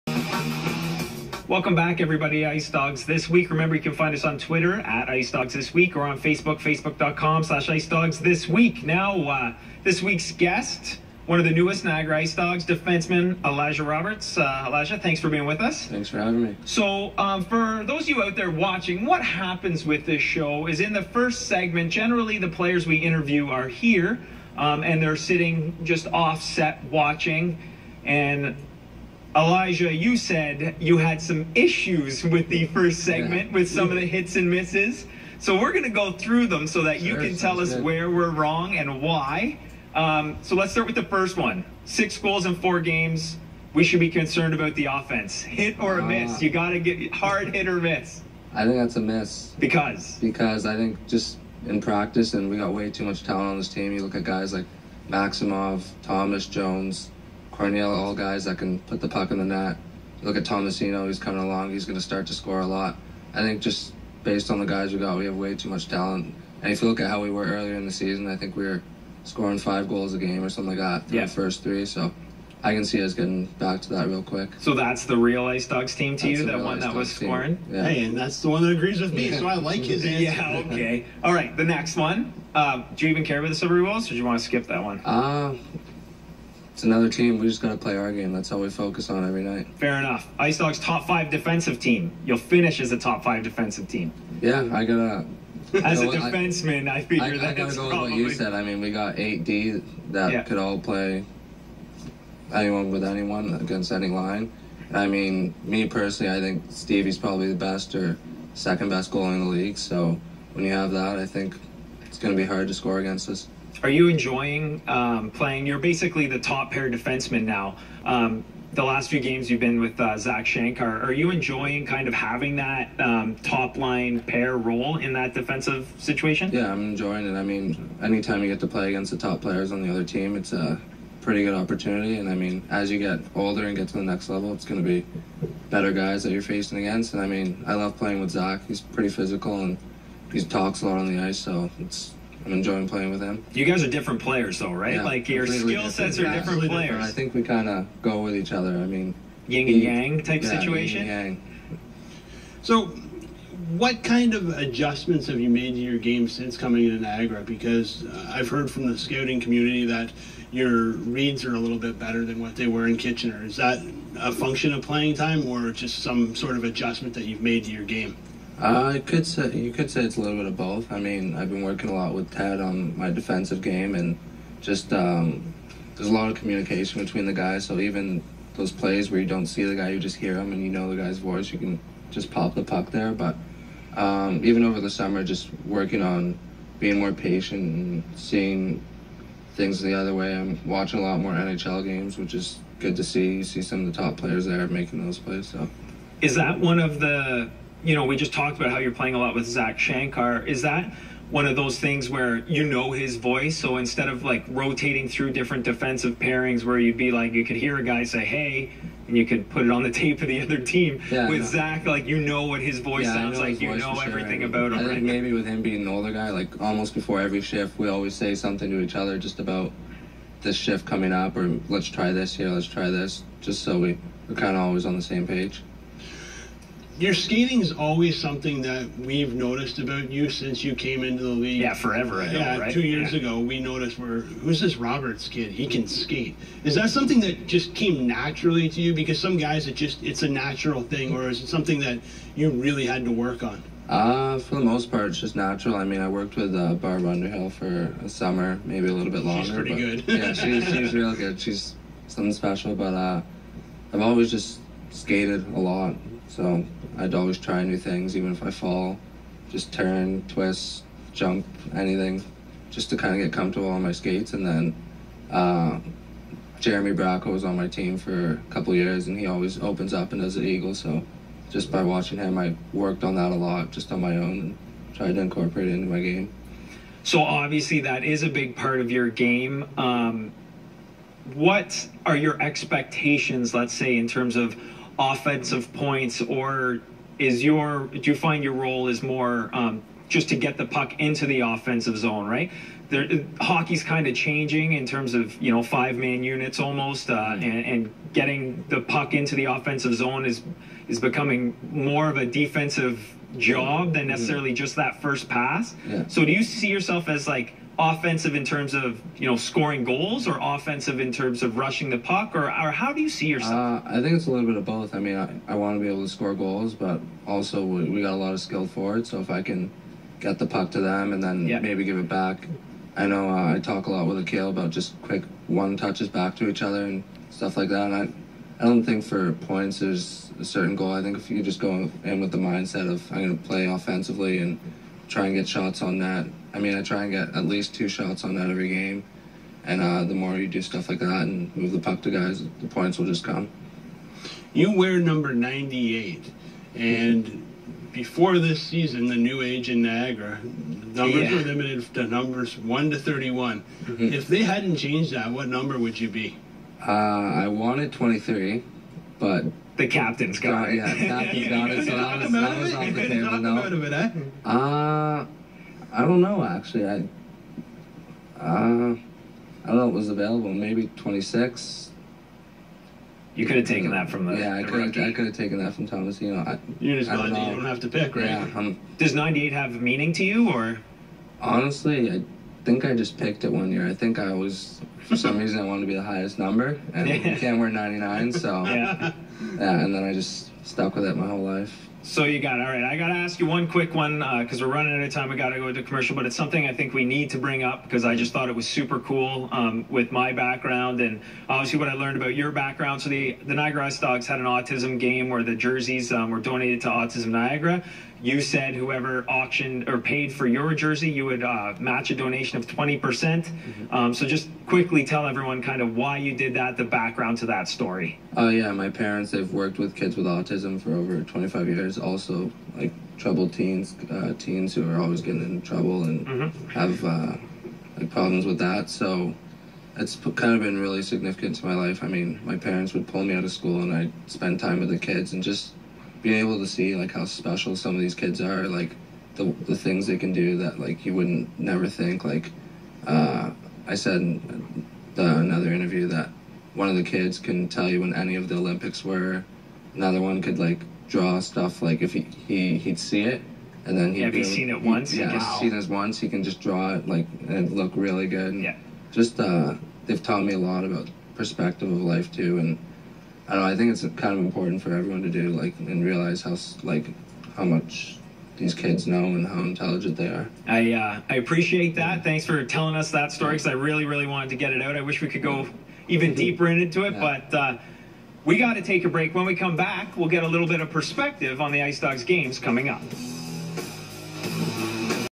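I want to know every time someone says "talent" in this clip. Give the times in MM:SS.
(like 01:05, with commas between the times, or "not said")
00:53, 01:05.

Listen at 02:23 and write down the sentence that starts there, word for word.
You guys are different players, though, right?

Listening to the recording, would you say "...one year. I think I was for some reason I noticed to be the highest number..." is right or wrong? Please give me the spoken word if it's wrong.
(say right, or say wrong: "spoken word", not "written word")
wrong: "wanted", not "noticed".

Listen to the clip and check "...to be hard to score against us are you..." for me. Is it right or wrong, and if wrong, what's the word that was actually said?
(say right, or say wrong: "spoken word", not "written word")
right.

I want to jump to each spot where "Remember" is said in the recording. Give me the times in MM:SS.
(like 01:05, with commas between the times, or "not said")
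00:03.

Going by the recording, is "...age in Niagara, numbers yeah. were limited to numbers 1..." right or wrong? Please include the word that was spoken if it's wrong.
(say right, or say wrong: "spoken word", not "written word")
right.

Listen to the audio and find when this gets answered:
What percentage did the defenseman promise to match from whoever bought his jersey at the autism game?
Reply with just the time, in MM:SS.
06:52.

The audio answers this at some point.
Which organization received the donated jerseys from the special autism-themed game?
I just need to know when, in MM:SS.
06:46.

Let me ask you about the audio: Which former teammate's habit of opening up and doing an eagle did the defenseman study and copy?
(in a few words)
Jeremy Bracco.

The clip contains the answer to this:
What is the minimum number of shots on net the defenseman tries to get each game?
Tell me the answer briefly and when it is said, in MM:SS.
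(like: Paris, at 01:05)
2, at 05:37.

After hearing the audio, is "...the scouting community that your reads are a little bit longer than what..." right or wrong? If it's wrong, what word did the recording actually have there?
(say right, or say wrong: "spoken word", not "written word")
wrong: "better", not "longer".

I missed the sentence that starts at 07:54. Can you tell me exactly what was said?
I wish we could go even deeper into it, yeah.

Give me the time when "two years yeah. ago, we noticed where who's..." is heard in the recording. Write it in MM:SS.
03:52.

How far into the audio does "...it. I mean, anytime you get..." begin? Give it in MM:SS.
02:07.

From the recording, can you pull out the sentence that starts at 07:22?
Like uh, I said in the, another interview that one of the kids can tell you when any of the Olympics were.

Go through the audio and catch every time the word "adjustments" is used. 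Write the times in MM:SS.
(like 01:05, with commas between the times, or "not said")
02:34, 02:46.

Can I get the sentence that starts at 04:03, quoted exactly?
Uh, for the most part, it's just natural.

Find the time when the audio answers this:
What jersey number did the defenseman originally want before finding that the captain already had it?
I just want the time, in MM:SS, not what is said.
05:57.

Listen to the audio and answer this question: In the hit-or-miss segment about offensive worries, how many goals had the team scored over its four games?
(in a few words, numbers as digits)
6.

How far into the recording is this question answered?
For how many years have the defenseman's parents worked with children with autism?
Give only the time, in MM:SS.
07:01.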